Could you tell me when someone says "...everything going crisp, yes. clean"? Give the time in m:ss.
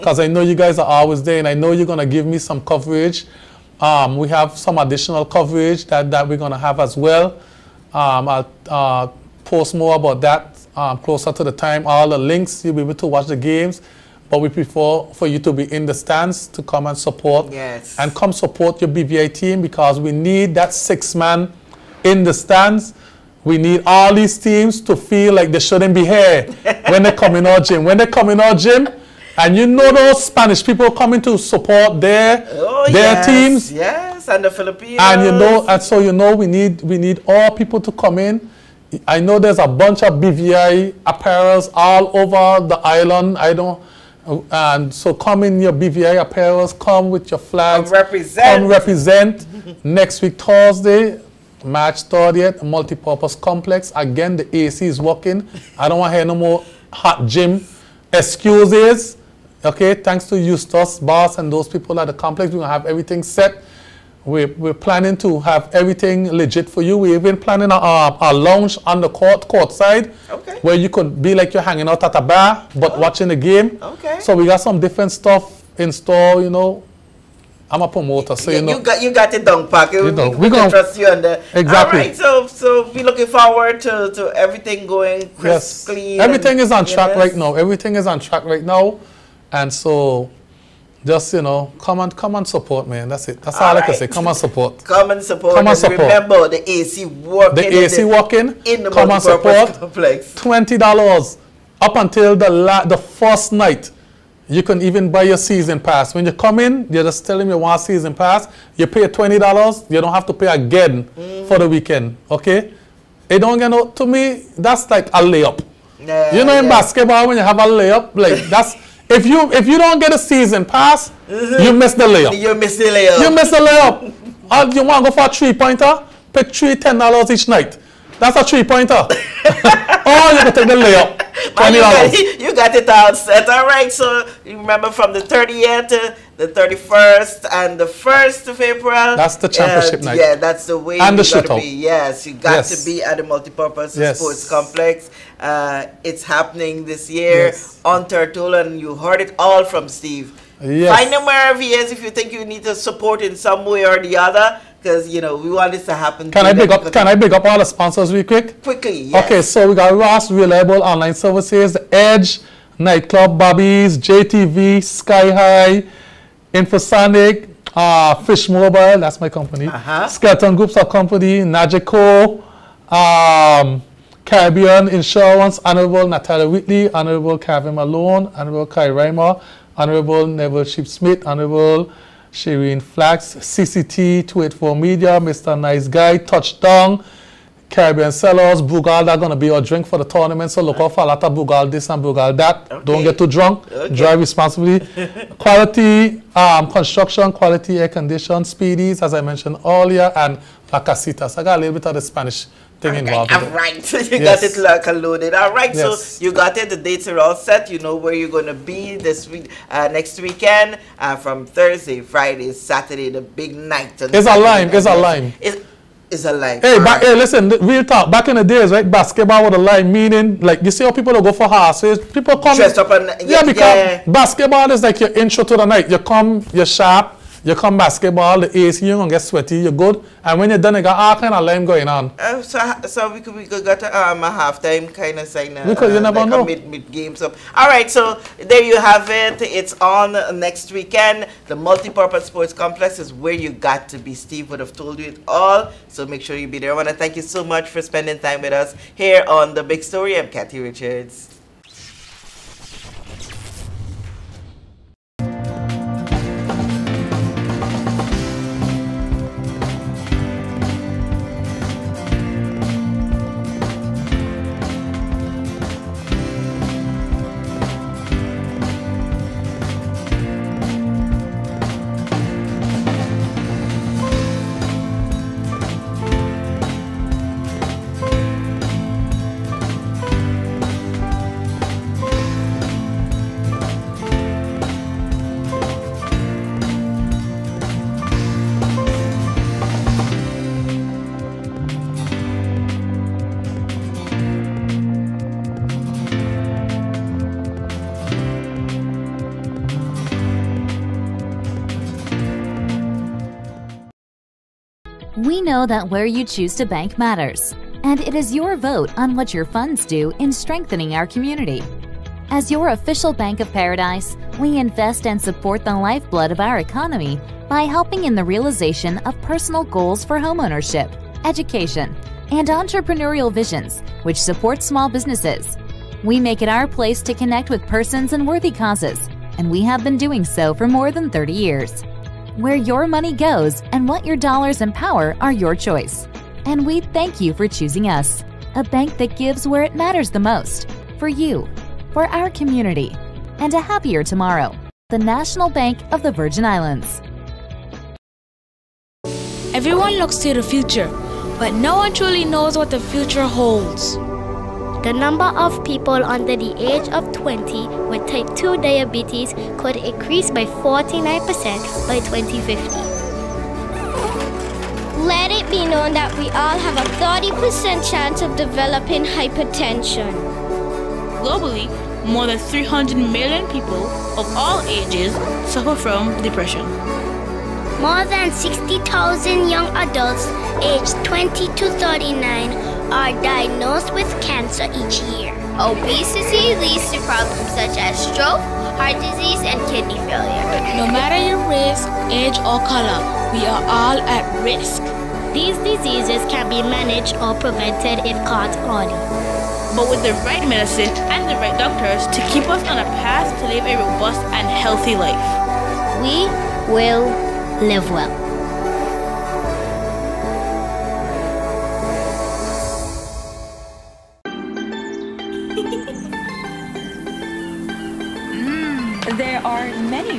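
1:24.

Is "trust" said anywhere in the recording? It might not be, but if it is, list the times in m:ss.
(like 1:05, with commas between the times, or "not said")
1:20.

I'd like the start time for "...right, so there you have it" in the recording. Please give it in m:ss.
3:57.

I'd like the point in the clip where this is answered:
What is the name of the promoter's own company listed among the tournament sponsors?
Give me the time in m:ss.
2:48.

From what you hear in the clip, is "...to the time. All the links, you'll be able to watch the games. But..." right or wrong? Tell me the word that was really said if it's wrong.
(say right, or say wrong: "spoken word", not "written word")
right.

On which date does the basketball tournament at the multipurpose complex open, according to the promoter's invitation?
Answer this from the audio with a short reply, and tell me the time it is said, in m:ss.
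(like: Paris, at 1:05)
March 30th, at 0:51.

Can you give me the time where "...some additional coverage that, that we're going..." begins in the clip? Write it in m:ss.
0:04.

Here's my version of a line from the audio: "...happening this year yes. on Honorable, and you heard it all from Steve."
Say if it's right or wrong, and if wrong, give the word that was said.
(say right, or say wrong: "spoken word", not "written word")
wrong: "Turtle", not "Honorable".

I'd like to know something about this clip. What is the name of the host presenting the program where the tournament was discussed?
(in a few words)
Kathy Richards.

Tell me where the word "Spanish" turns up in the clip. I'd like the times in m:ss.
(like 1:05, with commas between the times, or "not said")
0:30, 3:22.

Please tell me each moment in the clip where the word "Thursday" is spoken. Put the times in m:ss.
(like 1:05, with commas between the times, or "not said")
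0:50, 3:31.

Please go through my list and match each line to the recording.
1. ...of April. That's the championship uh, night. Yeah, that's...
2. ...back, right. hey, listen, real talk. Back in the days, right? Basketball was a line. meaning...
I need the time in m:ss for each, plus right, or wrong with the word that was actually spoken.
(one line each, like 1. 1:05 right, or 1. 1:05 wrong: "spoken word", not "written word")
1. 2:18 right
2. 3:36 right.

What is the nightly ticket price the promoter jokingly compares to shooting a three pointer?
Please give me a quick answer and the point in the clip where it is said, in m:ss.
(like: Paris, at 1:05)
$10, at 2:06.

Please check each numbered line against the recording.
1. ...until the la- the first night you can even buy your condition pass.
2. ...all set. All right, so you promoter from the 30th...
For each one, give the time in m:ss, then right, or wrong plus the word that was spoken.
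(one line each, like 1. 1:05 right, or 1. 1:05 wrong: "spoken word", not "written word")
1. 1:41 wrong: "season", not "condition"
2. 2:12 wrong: "remember", not "promoter".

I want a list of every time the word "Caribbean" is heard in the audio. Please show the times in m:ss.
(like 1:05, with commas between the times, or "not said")
2:54, 3:07.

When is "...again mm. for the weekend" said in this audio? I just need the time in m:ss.
1:50.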